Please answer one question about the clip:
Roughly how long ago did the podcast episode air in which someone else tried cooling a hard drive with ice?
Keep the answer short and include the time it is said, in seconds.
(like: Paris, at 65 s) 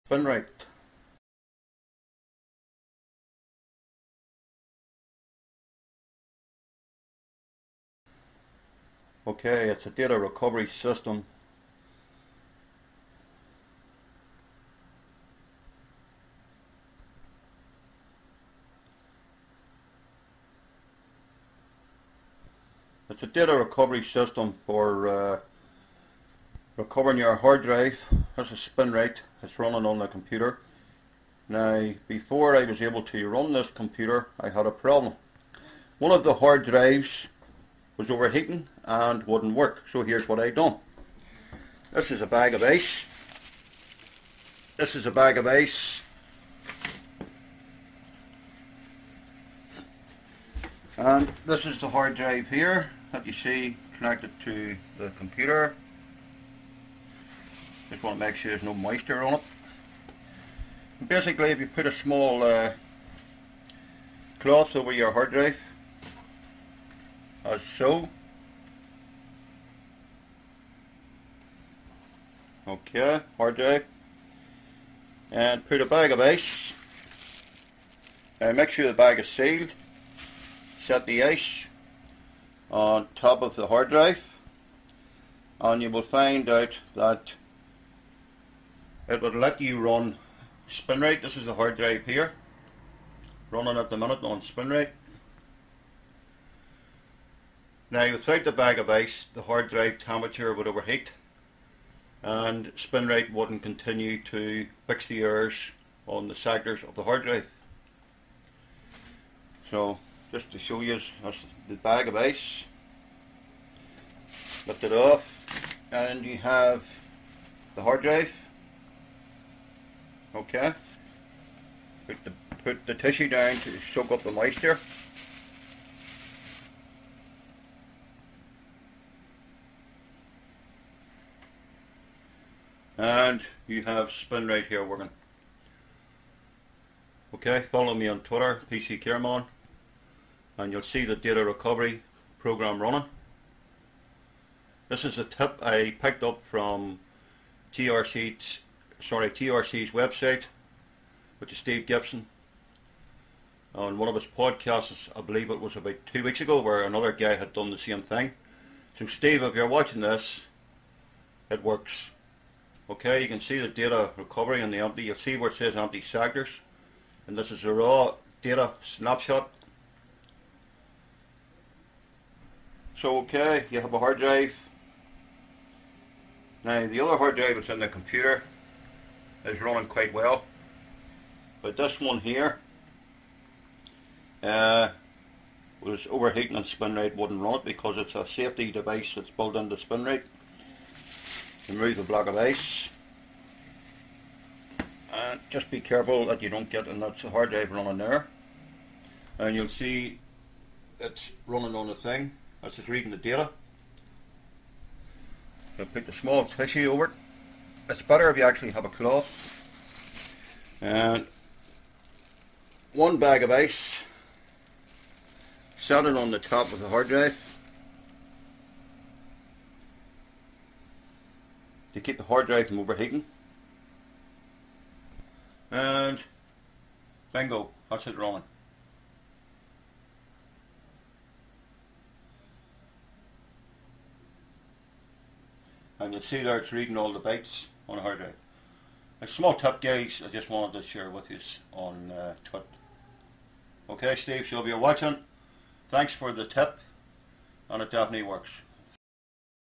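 about 2 weeks ago, at 155 s.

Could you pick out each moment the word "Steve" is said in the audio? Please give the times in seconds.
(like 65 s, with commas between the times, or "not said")
151 s, 159 s, 244 s.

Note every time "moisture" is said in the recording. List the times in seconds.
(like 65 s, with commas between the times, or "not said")
58 s, 124 s.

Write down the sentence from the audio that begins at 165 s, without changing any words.
You'll see where it says empty sectors.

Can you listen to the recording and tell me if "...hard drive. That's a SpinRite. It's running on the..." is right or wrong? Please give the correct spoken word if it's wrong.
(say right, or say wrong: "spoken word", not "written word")
right.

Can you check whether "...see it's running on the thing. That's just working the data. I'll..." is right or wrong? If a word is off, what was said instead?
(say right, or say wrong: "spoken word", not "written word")
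wrong: "reading", not "working".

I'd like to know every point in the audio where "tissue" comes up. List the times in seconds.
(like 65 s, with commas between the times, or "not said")
122 s, 206 s.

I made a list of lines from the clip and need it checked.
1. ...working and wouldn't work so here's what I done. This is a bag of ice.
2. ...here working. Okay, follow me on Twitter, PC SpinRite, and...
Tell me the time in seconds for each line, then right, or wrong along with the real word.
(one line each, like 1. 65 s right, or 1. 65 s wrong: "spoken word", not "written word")
1. 38 s wrong: "overheating", not "working"
2. 134 s wrong: "Careman", not "SpinRite".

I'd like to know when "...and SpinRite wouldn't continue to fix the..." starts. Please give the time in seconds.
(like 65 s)
102 s.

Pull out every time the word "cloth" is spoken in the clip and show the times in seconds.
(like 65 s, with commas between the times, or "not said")
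64 s, 208 s.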